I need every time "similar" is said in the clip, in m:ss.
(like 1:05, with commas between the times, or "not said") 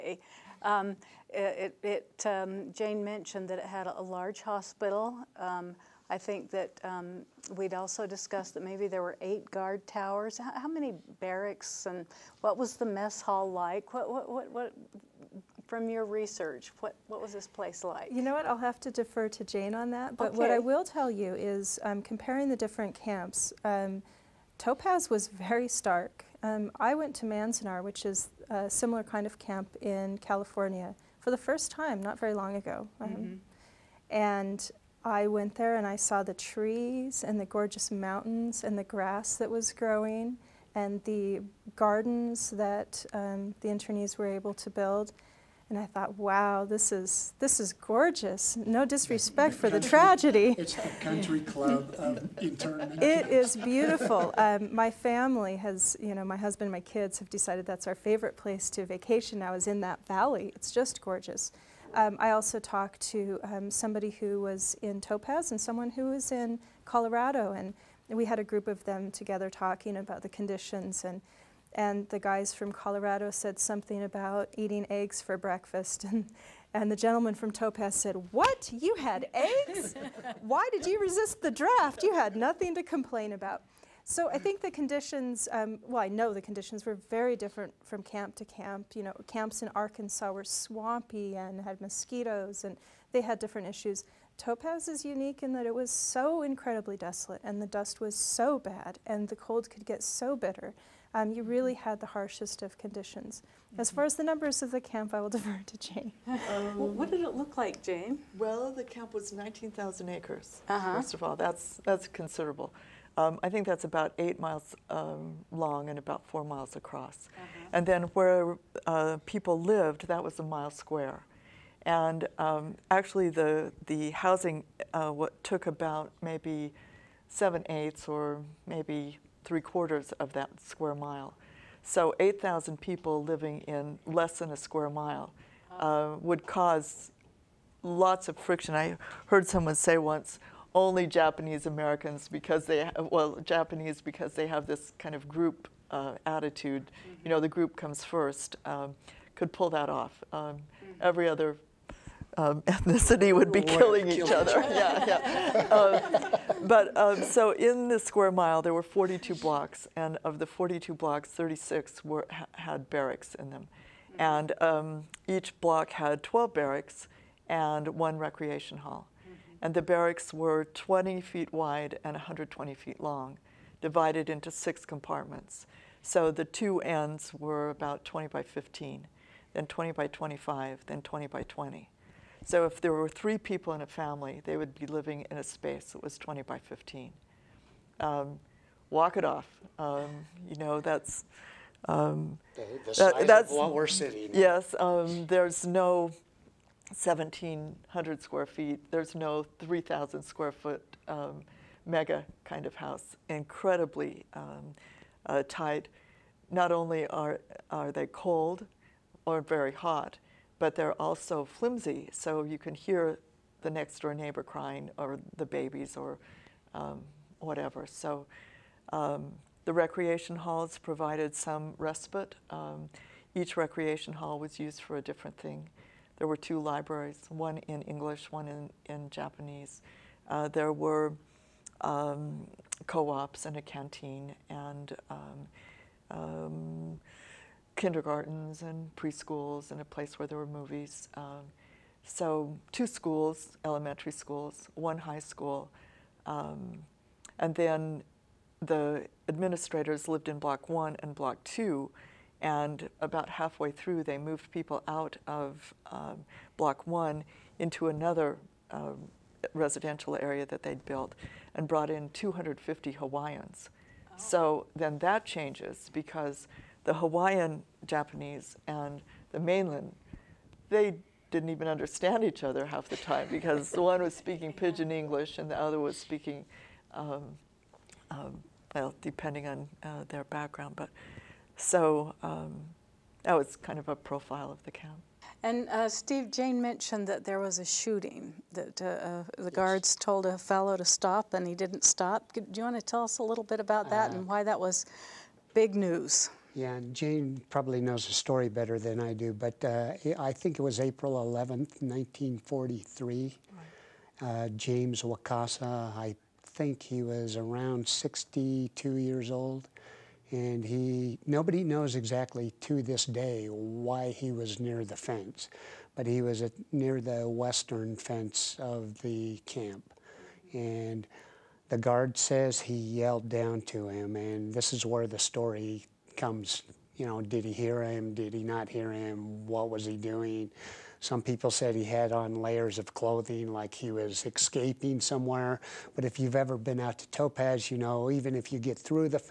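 0:28.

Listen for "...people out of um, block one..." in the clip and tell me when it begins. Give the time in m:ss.
4:14.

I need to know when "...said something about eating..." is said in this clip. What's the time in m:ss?
1:13.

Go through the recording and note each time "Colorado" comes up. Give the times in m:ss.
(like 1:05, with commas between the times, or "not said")
1:06, 1:12.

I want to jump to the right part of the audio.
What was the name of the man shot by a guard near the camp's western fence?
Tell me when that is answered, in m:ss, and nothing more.
5:04.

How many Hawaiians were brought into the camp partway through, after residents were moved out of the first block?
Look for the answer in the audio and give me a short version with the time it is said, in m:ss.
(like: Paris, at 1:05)
250, at 4:22.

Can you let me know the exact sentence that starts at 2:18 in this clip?
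I heard someone say once, only Japanese Americans because they well Japanese because they have this kind of group uh, attitude.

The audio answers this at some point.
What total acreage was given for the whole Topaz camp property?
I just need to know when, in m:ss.
1:49.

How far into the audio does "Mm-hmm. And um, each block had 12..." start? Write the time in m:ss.
2:44.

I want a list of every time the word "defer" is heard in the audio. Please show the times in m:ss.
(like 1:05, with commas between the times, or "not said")
0:18, 1:45.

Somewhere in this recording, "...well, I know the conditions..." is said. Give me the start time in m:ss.
1:25.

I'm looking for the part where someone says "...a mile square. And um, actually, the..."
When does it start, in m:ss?
2:00.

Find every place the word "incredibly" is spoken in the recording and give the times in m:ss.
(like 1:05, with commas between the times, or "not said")
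1:36, 3:23.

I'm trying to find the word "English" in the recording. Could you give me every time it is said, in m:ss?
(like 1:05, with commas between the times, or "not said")
3:47, 4:34.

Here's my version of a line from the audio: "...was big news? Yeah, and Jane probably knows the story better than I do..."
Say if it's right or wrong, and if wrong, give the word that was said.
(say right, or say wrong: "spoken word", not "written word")
right.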